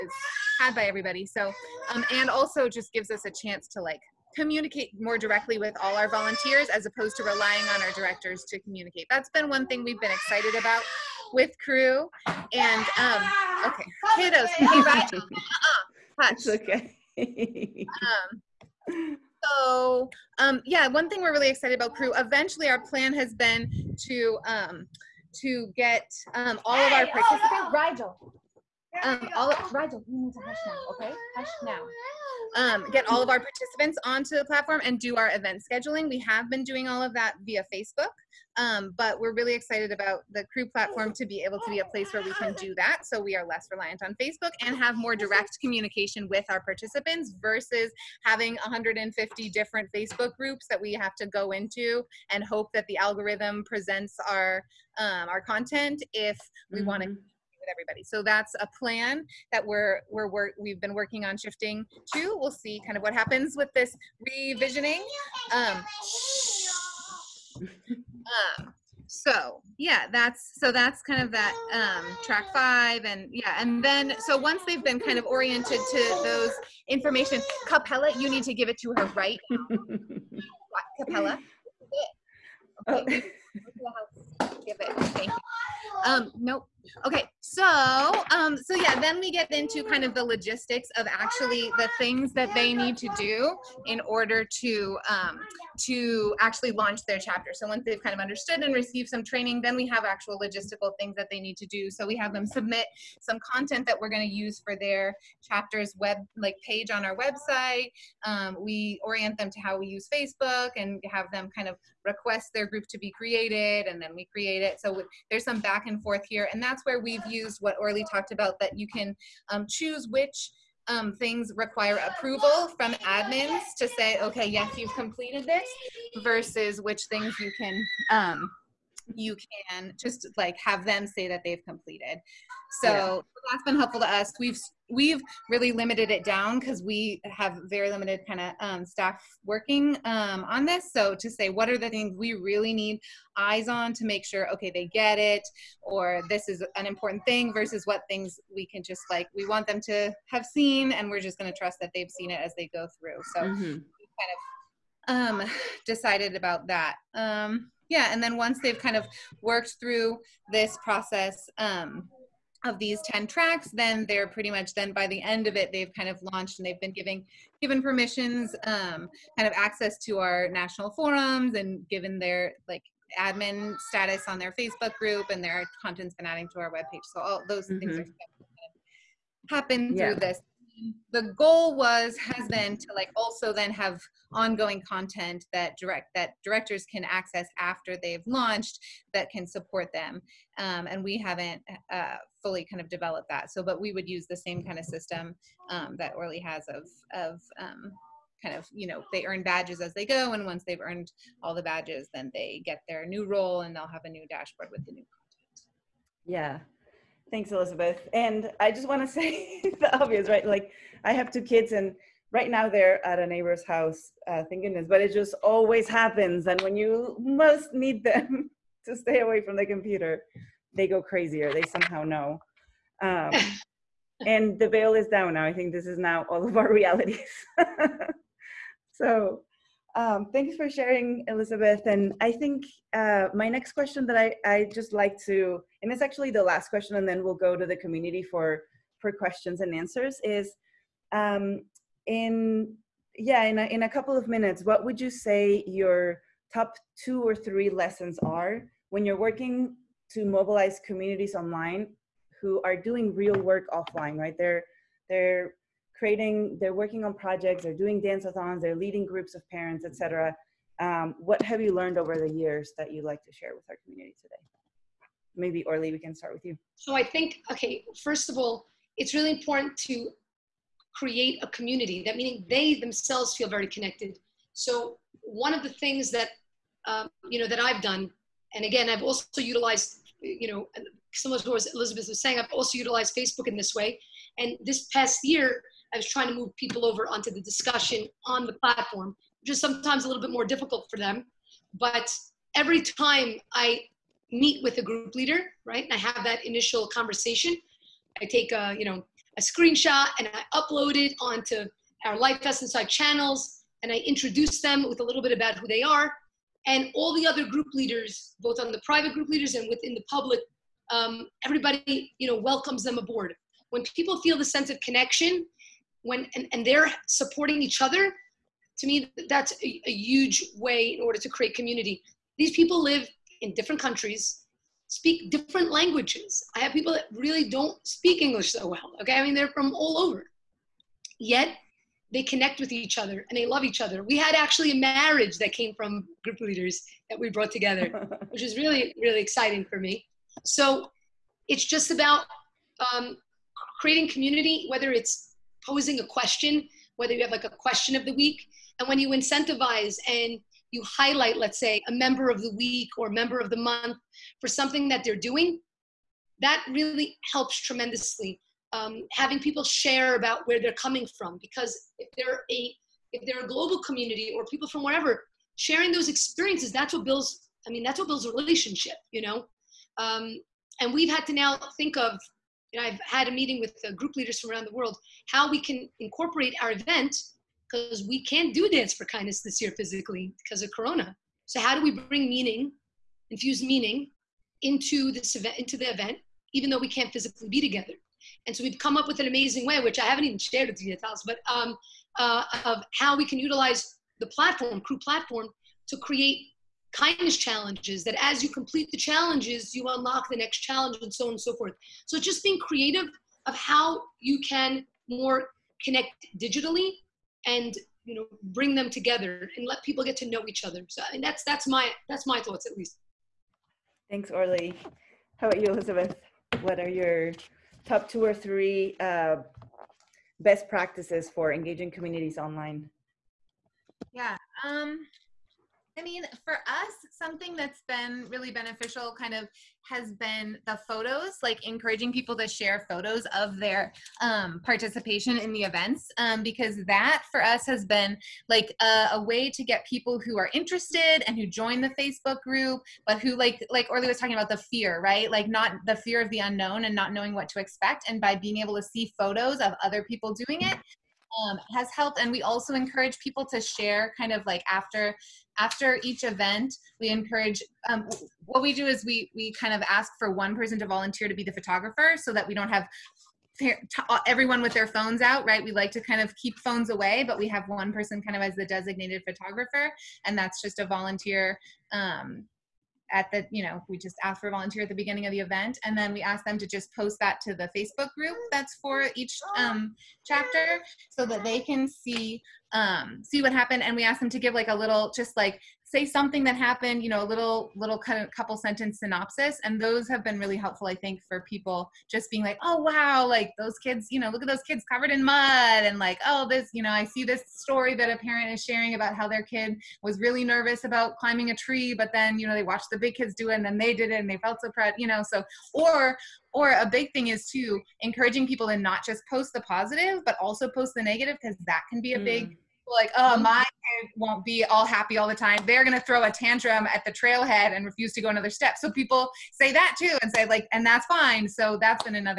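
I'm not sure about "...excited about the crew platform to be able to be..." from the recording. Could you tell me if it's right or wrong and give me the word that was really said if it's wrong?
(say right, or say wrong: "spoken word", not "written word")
right.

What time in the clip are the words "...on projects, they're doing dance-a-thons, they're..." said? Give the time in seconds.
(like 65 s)
257 s.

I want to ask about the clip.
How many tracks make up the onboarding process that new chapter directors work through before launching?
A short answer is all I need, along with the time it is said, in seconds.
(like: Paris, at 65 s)
10, at 163 s.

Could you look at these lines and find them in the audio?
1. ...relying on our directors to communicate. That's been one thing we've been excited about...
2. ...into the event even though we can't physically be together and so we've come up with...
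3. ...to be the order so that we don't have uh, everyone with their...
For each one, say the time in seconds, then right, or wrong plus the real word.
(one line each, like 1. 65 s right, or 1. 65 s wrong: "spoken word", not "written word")
1. 7 s right
2. 385 s right
3. 461 s wrong: "photographer", not "order".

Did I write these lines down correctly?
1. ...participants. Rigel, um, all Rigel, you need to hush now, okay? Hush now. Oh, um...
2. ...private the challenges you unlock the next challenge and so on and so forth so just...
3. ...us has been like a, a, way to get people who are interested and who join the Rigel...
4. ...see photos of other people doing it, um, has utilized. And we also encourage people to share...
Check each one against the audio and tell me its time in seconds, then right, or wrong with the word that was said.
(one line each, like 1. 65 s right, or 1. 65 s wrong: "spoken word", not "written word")
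1. 27 s right
2. 398 s wrong: "complete", not "private"
3. 437 s wrong: "Facebook", not "Rigel"
4. 448 s wrong: "helped", not "utilized".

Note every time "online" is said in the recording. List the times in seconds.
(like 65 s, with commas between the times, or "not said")
251 s, 422 s.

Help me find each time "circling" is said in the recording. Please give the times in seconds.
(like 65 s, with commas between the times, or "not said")
not said.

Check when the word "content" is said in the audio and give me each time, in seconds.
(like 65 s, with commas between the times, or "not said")
55 s, 103 s, 175 s, 184 s, 205 s.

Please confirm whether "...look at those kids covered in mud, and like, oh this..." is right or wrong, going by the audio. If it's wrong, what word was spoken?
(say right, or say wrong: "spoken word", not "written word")
right.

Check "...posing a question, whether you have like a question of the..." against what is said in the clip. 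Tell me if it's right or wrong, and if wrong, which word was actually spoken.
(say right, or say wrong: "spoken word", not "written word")
right.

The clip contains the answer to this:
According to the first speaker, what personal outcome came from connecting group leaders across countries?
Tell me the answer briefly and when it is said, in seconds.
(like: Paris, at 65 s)
a marriage, at 334 s.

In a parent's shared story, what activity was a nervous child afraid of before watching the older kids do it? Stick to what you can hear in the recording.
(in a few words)
climbing a tree.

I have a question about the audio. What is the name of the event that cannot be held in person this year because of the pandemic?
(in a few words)
Dance for Kindness.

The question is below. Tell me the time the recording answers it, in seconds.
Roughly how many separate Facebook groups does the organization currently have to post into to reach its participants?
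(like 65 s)
48 s.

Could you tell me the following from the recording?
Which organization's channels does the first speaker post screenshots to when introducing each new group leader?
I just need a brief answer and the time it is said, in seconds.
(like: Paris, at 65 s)
LifeVest Inside, at 302 s.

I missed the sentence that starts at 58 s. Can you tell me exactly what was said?
So that's a plan that we're we're we've been working on shifting to.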